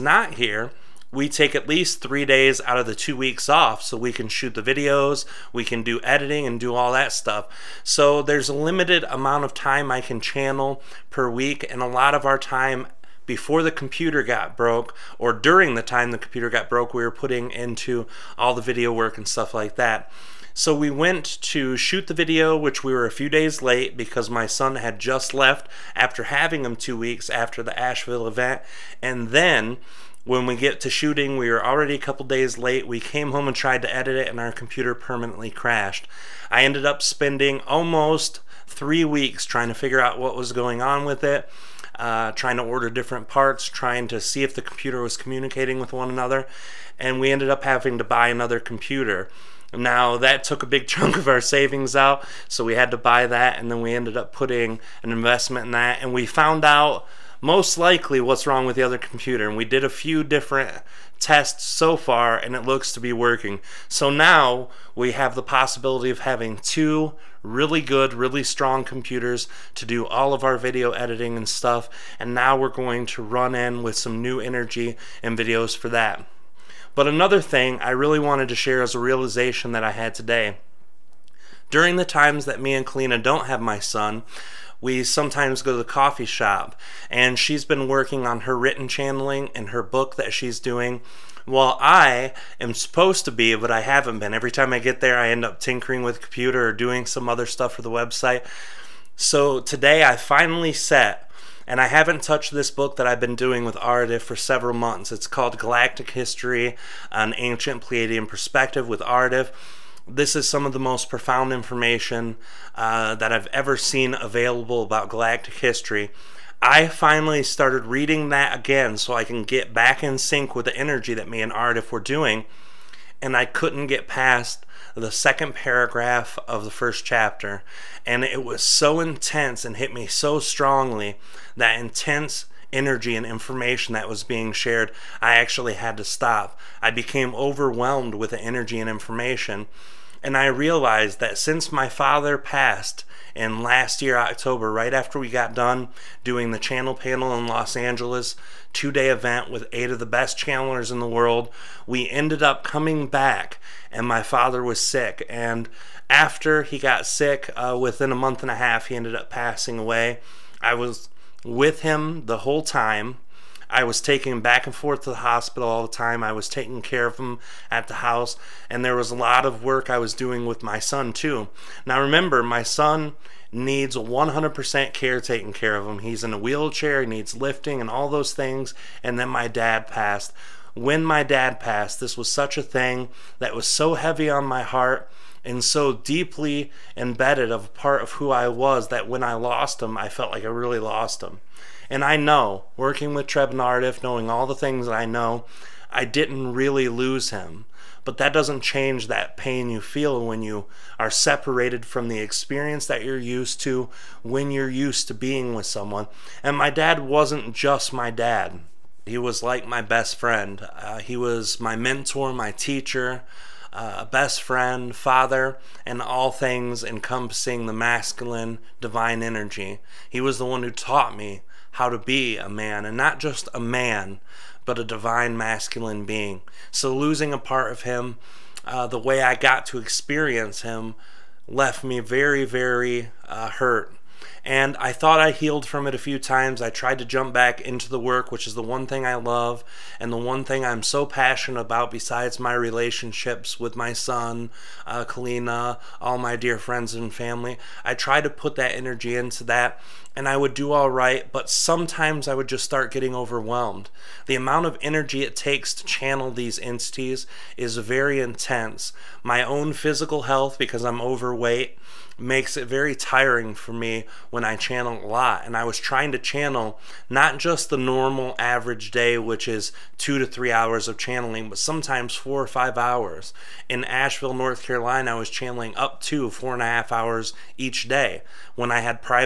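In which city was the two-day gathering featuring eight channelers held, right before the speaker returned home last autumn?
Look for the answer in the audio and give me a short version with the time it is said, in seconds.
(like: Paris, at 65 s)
Los Angeles, at 147 s.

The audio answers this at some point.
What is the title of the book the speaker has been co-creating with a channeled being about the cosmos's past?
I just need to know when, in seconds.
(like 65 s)
105 s.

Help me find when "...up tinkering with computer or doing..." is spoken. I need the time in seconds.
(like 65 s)
95 s.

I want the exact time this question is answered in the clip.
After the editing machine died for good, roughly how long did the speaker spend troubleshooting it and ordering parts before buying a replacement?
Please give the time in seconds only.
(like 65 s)
37 s.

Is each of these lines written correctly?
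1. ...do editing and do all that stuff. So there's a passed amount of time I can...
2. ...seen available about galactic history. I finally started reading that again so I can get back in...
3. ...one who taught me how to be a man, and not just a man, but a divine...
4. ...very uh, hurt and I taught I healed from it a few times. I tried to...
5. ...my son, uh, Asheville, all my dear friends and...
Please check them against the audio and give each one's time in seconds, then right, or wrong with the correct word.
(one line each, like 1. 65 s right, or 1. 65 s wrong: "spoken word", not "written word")
1. 5 s wrong: "limited", not "passed"
2. 113 s right
3. 220 s right
4. 232 s wrong: "thought", not "taught"
5. 243 s wrong: "Kalina", not "Asheville".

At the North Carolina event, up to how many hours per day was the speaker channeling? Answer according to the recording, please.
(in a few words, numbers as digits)
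4.5 hours.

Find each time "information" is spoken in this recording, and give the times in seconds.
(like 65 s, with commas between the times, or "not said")
111 s, 133 s, 138 s.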